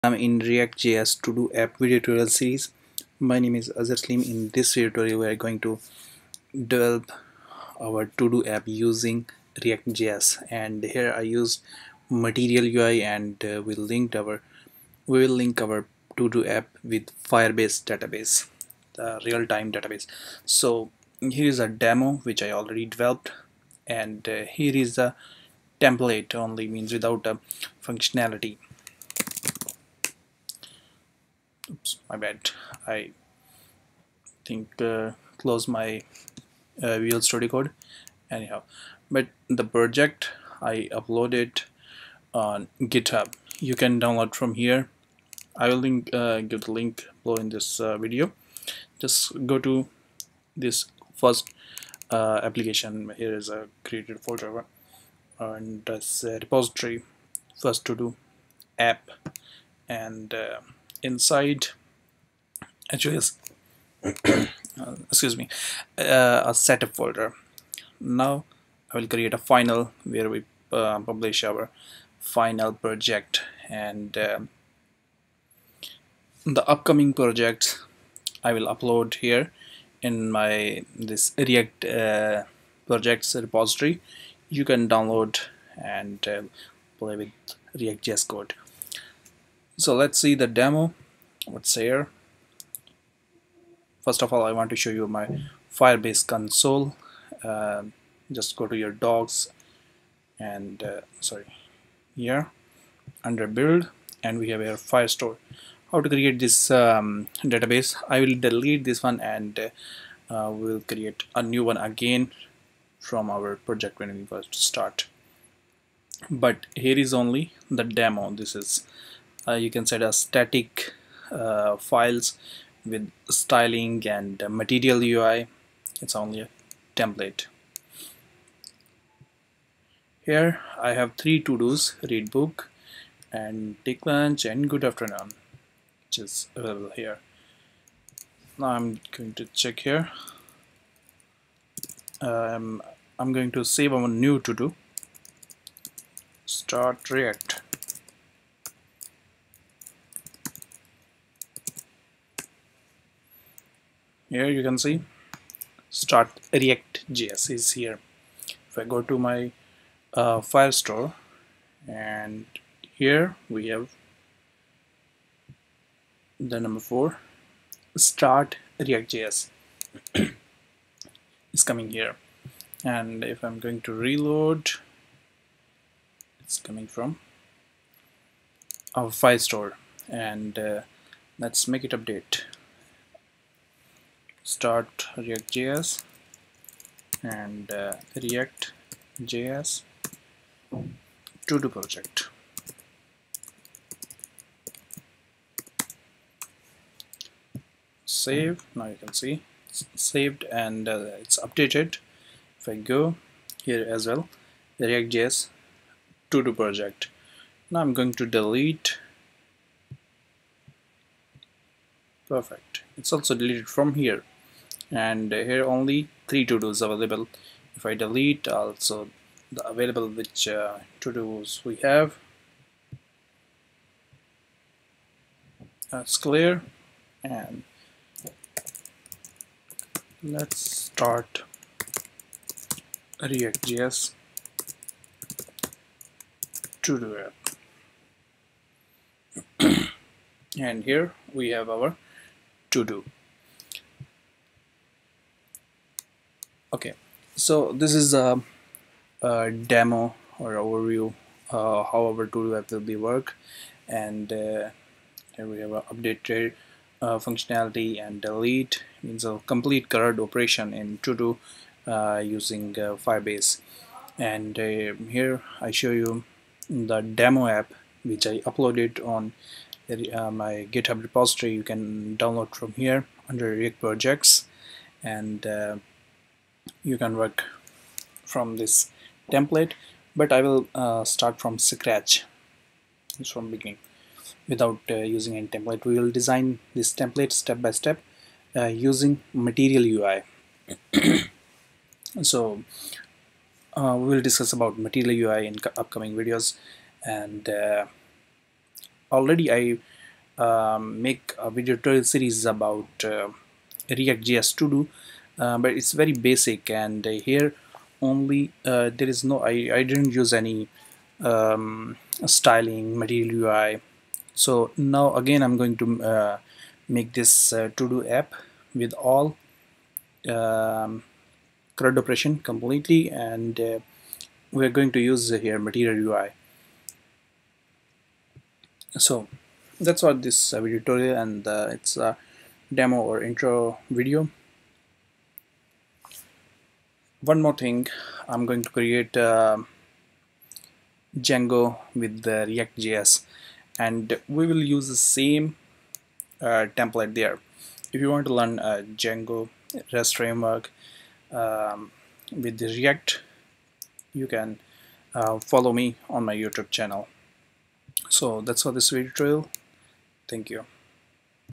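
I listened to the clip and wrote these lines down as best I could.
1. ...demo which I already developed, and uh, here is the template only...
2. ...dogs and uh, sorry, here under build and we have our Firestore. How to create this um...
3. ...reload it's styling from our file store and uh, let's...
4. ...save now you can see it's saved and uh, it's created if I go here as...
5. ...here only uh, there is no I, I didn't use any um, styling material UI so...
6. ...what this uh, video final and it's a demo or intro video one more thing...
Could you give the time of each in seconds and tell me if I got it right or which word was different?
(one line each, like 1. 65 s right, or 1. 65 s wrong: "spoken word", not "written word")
1. 21 s right
2. 98 s right
3. 174 s wrong: "coming", not "styling"
4. 198 s wrong: "updated", not "created"
5. 307 s right
6. 330 s wrong: "tutorial", not "final".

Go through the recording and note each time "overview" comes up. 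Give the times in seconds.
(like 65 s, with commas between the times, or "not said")
250 s.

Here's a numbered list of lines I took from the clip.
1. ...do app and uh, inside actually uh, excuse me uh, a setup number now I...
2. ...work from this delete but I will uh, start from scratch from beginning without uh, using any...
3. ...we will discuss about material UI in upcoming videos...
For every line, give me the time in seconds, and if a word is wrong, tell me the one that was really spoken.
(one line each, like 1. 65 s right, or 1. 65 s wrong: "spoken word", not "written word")
1. 57 s wrong: "folder", not "number"
2. 277 s wrong: "template", not "delete"
3. 293 s right.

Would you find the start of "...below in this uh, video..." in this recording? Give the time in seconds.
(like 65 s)
47 s.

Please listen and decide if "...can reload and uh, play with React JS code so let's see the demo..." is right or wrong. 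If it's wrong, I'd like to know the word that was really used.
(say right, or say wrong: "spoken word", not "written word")
wrong: "download", not "reload".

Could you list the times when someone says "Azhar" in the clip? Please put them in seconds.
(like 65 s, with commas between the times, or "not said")
3 s.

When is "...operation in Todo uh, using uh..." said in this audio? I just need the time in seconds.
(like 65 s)
260 s.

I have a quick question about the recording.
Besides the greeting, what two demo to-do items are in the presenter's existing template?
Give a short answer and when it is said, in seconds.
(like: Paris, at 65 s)
read book and take lunch, at 132 s.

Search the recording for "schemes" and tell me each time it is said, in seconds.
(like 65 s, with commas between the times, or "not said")
not said.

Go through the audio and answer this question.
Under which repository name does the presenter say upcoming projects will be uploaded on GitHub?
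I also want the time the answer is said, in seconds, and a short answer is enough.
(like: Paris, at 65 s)
react projects, at 81 s.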